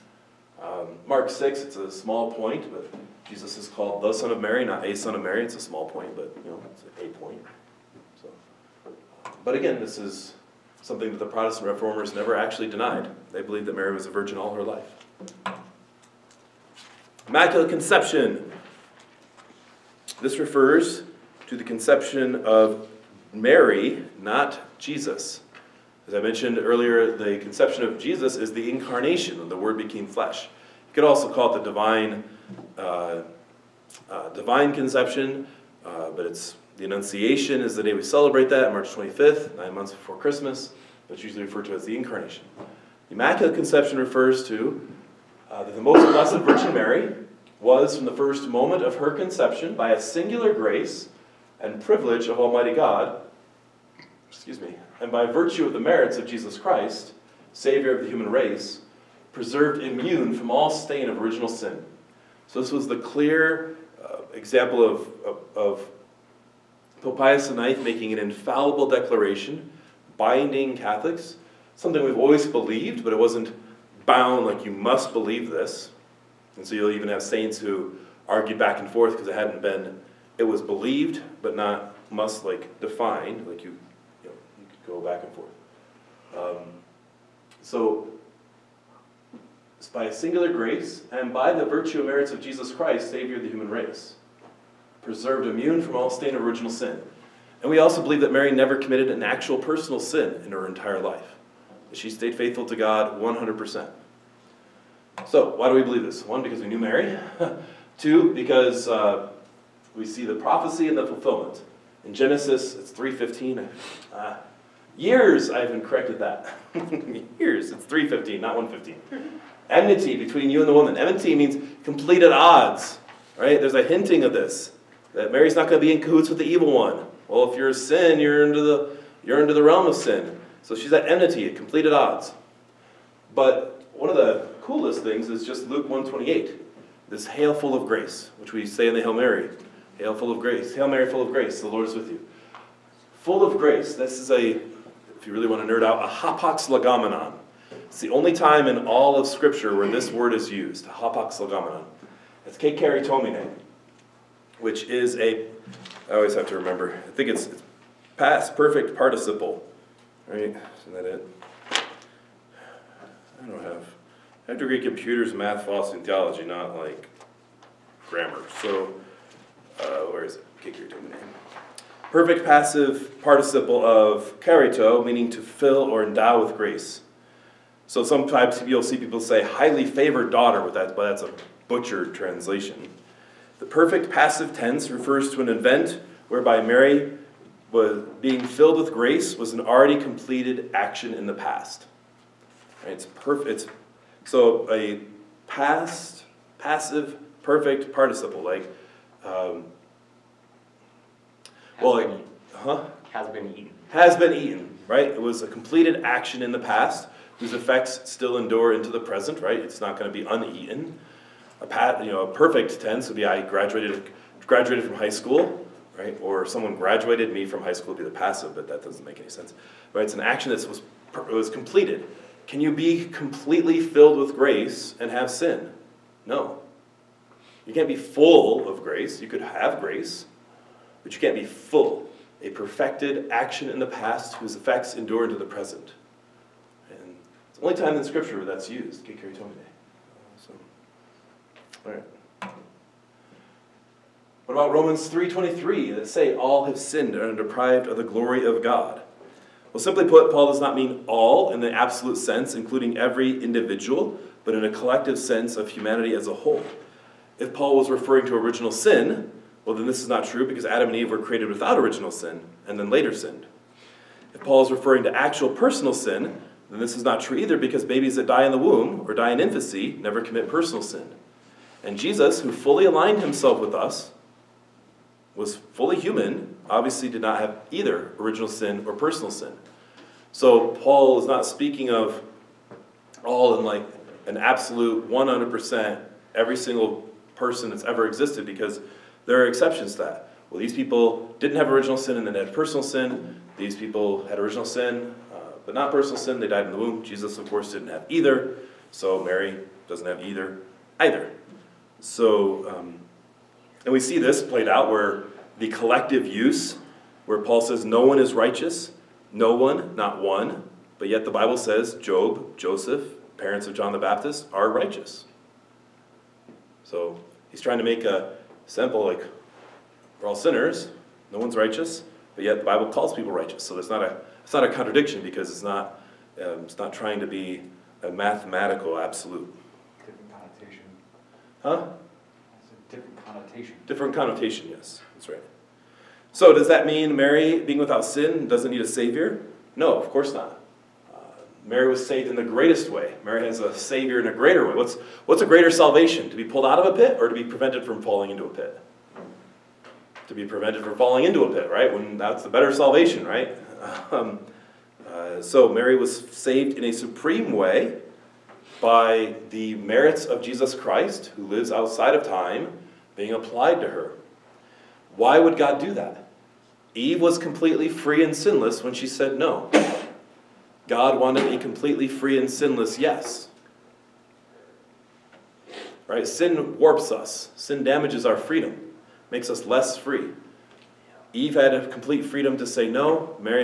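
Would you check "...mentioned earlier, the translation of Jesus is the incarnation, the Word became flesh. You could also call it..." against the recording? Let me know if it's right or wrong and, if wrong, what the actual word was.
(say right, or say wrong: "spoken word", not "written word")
wrong: "conception", not "translation".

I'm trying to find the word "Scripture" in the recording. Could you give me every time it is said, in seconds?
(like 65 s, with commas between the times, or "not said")
149 s, 238 s.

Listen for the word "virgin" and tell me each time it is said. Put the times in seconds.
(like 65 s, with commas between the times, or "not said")
14 s, 46 s.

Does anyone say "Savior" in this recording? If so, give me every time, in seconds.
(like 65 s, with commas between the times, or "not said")
57 s, 93 s, 338 s, 343 s.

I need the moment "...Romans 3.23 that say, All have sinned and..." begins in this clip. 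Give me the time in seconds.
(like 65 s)
244 s.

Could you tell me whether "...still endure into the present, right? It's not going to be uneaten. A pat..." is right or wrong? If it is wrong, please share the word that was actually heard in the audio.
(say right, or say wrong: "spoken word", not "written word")
right.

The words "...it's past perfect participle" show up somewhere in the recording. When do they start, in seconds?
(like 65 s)
157 s.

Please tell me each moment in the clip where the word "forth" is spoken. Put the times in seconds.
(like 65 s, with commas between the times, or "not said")
78 s, 85 s.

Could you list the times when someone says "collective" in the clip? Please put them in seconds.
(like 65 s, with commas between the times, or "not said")
254 s, 305 s.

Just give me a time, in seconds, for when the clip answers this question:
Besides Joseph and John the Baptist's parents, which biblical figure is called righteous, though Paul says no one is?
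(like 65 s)
311 s.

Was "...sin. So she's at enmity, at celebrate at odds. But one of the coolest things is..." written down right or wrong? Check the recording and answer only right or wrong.
wrong.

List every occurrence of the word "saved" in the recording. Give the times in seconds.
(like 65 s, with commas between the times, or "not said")
342 s, 356 s.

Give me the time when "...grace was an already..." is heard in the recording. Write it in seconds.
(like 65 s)
188 s.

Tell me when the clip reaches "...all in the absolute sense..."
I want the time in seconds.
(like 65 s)
251 s.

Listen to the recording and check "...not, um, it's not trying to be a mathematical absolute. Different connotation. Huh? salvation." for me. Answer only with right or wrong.
wrong.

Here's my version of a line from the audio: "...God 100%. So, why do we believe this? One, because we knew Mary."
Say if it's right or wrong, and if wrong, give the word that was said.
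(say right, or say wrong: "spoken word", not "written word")
right.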